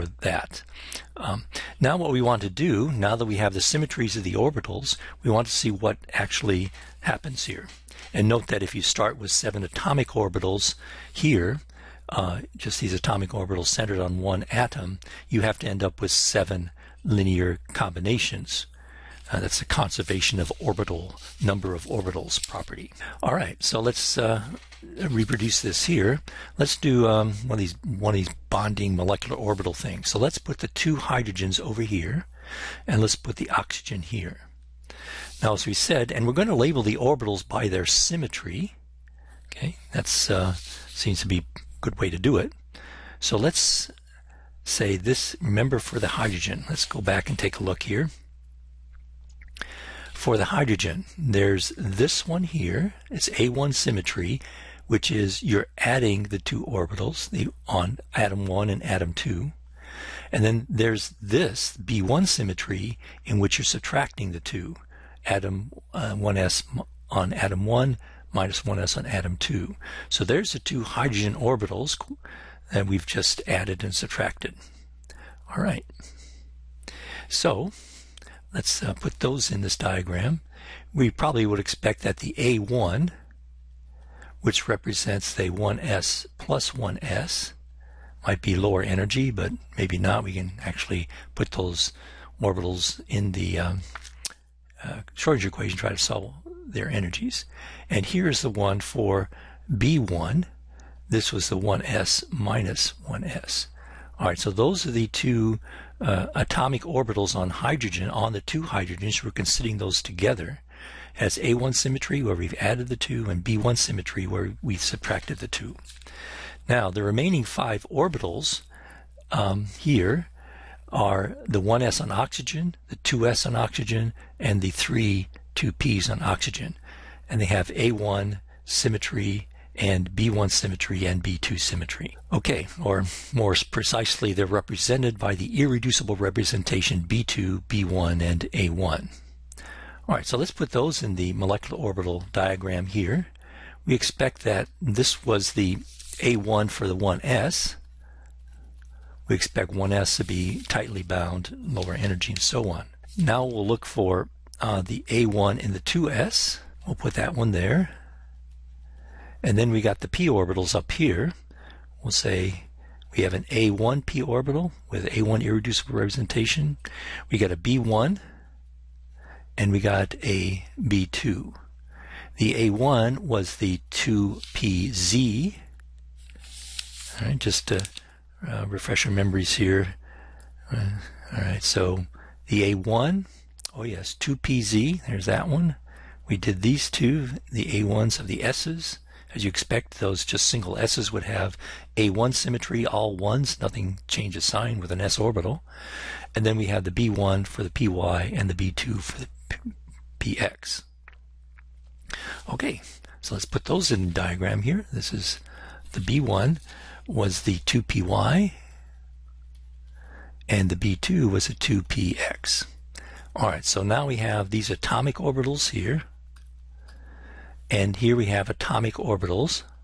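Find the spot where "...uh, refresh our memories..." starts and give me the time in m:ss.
2:58.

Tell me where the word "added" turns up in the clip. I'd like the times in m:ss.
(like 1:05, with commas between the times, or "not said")
1:13, 1:52.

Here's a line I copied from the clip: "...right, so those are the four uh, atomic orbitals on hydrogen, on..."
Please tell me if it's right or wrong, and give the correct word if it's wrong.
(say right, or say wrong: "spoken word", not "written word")
wrong: "two", not "four".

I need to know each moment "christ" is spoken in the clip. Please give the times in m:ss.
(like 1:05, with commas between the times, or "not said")
not said.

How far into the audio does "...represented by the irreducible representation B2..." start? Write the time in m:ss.
2:14.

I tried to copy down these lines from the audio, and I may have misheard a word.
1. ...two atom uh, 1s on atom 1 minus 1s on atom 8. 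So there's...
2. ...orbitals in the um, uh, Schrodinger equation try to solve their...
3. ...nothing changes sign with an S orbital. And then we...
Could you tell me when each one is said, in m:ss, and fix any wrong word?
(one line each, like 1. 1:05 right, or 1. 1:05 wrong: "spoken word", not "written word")
1. 1:04 wrong: "2", not "8"
2. 1:32 right
3. 3:13 right.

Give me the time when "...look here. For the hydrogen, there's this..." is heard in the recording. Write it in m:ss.
0:47.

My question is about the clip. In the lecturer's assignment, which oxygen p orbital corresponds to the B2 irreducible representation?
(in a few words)
2px.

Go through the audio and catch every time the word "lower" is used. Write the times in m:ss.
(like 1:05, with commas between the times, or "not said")
1:28, 2:31.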